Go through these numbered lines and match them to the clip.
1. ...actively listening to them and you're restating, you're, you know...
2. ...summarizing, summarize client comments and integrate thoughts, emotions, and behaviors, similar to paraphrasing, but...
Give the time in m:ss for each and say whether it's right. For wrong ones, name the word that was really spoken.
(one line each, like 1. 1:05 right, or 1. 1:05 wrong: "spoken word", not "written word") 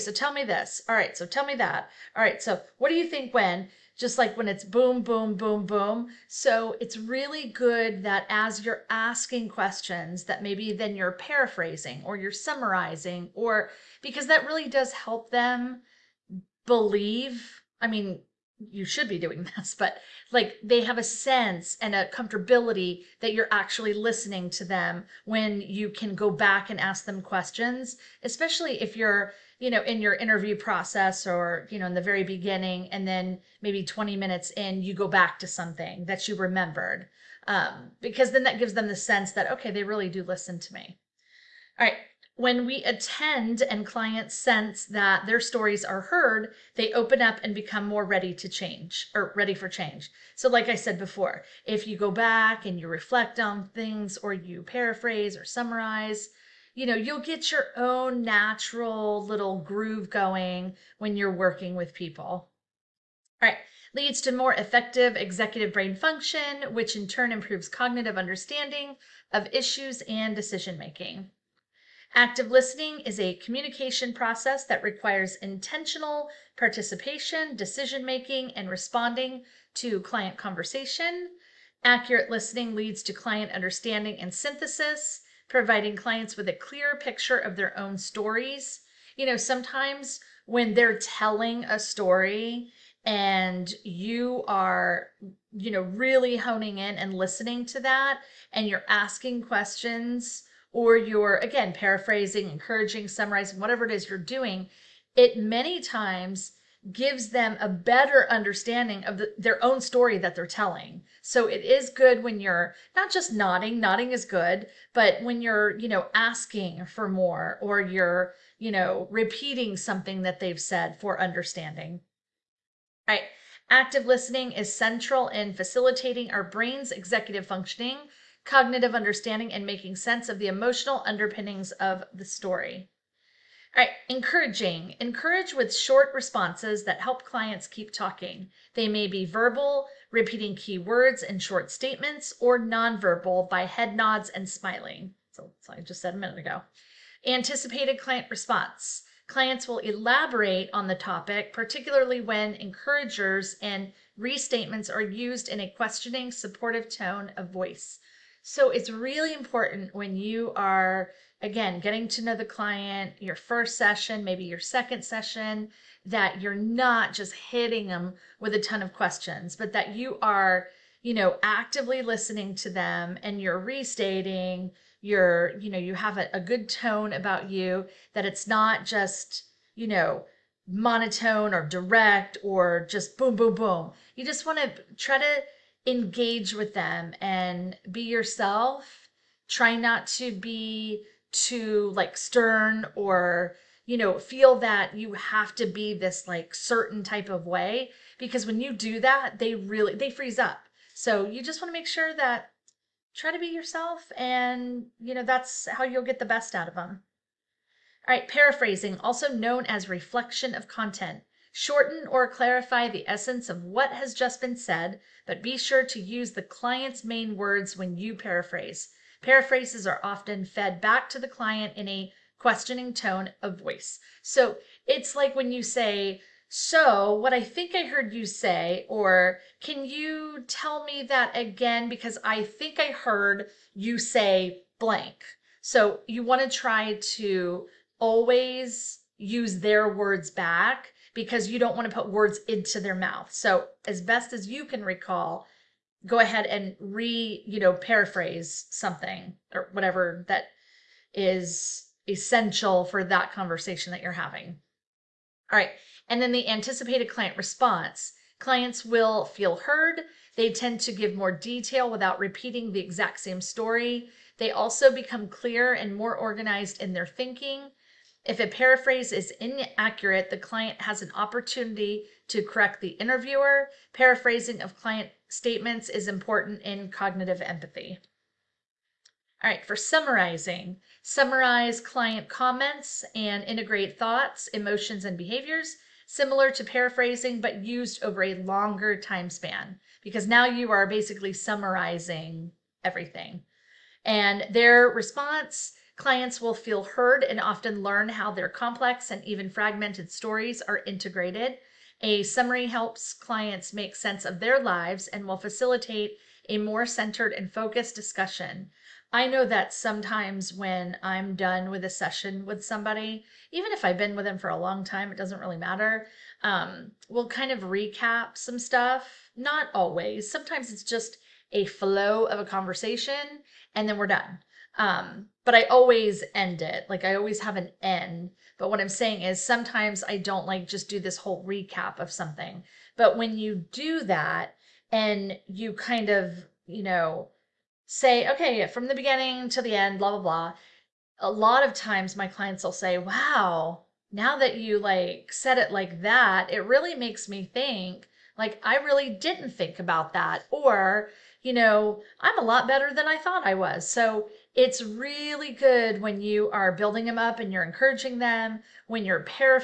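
1. 2:51 right
2. 4:39 right.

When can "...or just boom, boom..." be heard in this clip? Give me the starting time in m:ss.
3:02.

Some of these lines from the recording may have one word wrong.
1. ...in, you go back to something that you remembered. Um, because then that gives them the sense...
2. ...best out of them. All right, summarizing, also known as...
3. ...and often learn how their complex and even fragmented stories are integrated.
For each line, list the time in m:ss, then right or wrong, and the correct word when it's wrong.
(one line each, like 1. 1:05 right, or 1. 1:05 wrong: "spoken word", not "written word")
1. 0:34 right
2. 3:26 wrong: "paraphrasing", not "summarizing"
3. 4:57 right.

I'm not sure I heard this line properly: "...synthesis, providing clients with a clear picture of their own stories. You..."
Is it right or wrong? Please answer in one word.
right.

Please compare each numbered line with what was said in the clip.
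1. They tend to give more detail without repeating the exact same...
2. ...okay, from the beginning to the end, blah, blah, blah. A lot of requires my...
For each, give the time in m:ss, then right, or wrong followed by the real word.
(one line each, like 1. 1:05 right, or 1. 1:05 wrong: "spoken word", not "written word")
1. 4:20 right
2. 5:38 wrong: "times", not "requires".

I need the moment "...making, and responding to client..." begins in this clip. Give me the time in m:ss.
1:18.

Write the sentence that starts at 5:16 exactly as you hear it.
Um, we'll kind of recap some stuff.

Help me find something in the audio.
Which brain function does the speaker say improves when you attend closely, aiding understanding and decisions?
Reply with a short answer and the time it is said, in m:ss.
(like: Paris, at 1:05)
executive brain function, at 1:05.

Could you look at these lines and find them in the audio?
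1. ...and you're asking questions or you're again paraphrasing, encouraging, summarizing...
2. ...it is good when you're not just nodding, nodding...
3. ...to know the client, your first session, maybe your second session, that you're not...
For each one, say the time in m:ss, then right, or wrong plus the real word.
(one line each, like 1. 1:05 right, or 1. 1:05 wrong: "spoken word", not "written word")
1. 1:38 right
2. 1:51 right
3. 2:42 right.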